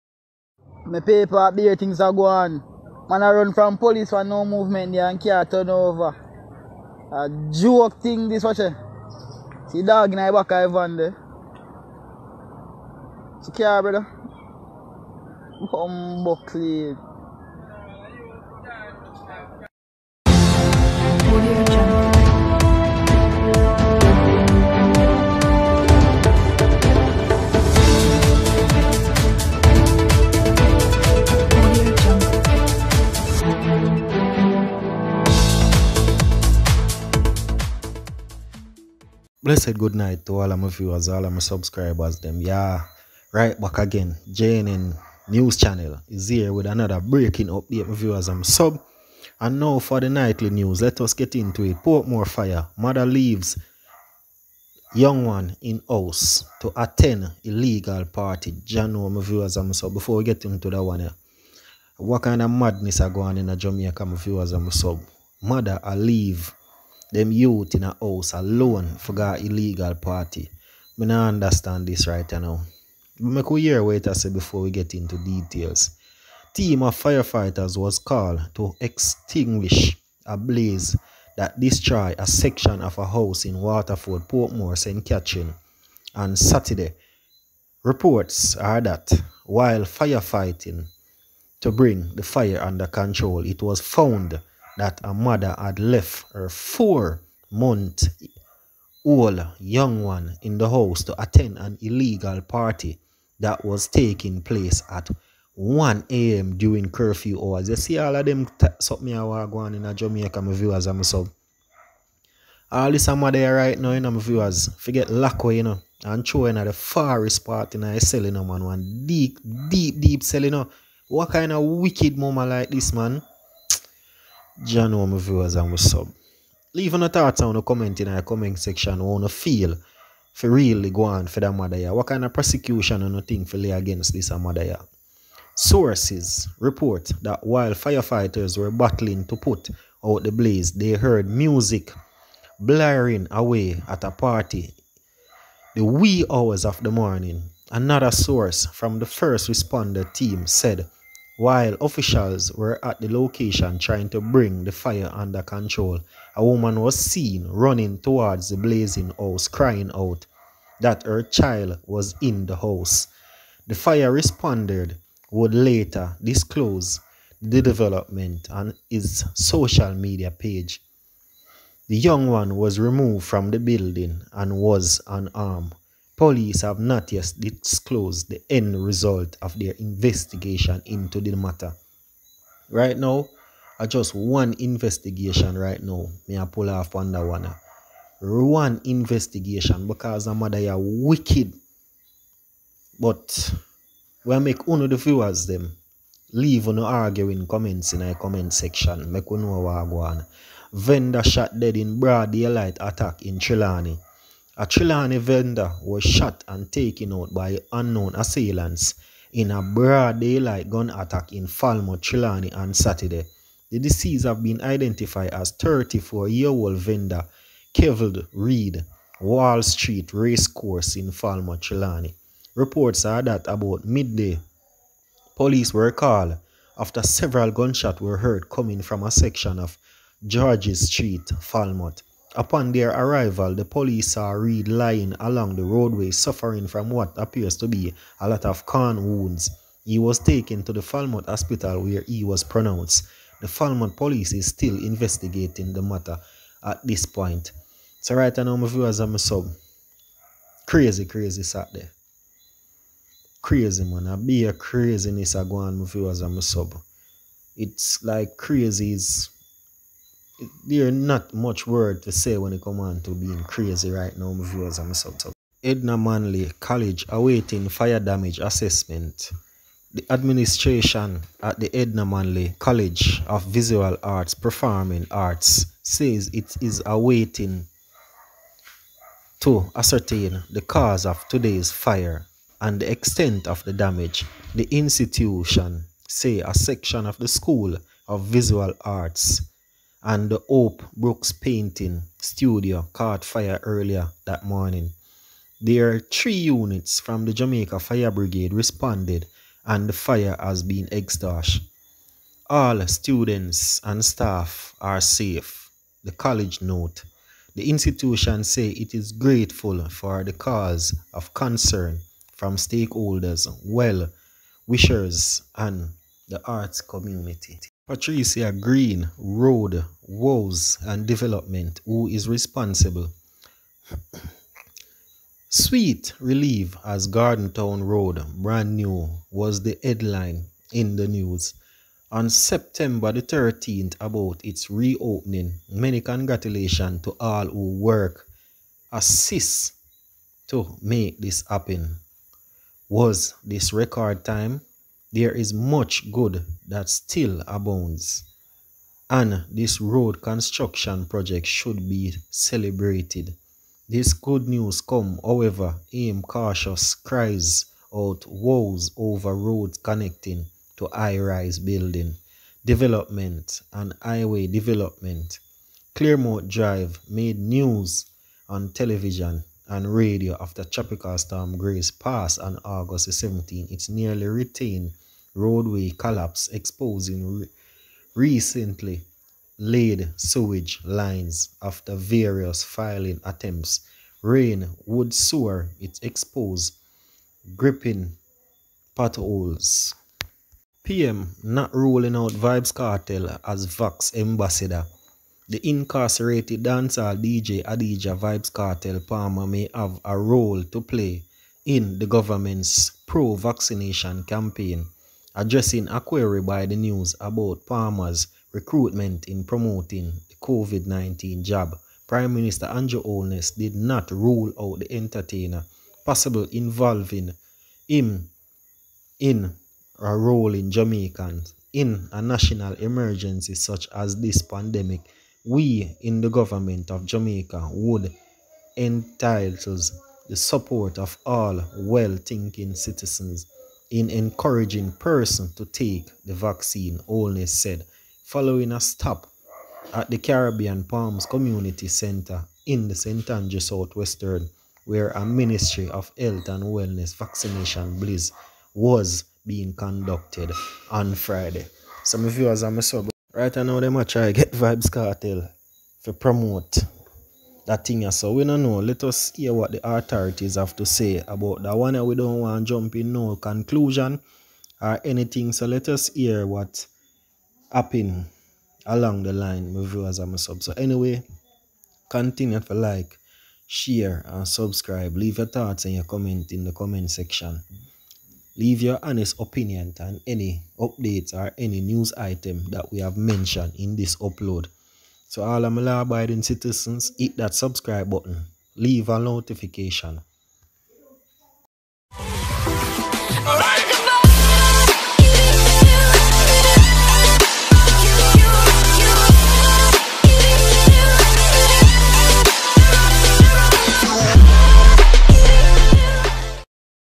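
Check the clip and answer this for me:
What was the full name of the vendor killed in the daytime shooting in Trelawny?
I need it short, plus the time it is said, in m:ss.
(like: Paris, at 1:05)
Keveld Reed, at 3:37.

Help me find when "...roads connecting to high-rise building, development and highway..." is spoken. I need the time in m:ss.
5:59.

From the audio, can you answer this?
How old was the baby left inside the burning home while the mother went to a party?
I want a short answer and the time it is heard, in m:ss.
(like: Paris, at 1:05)
4 months, at 1:36.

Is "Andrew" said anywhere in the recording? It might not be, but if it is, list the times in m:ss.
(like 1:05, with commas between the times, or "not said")
6:52, 7:23.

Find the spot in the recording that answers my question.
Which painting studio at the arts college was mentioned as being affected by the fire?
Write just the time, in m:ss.
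4:50.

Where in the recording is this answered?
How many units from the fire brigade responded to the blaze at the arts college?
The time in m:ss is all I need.
4:55.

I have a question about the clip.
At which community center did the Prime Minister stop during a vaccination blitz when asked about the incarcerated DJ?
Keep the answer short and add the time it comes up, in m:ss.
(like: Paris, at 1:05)
Caribbean Palms Community Center, at 7:20.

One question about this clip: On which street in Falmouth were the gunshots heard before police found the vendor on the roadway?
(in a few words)
Georges Street.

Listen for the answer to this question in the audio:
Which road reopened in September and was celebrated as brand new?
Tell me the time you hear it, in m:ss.
5:27.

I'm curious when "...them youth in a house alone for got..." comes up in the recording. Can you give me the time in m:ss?
1:07.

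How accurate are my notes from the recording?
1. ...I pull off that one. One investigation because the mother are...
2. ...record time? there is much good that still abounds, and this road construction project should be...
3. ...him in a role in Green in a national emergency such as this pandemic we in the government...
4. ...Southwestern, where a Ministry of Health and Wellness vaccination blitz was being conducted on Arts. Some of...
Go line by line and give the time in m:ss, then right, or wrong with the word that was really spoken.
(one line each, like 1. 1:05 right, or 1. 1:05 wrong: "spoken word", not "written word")
1. 3:06 right
2. 5:43 right
3. 6:57 wrong: "Jamaicans", not "Green"
4. 7:23 wrong: "Friday", not "Arts".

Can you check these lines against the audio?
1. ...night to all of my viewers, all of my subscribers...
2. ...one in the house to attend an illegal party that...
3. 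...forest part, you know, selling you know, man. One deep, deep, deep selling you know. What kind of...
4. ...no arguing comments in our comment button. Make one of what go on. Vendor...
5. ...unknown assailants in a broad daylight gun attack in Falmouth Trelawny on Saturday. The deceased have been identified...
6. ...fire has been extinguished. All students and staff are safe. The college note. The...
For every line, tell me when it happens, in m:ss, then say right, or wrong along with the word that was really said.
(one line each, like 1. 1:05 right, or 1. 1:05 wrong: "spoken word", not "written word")
1. 0:39 right
2. 1:40 right
3. 1:56 right
4. 3:16 wrong: "section", not "button"
5. 3:27 right
6. 4:59 right.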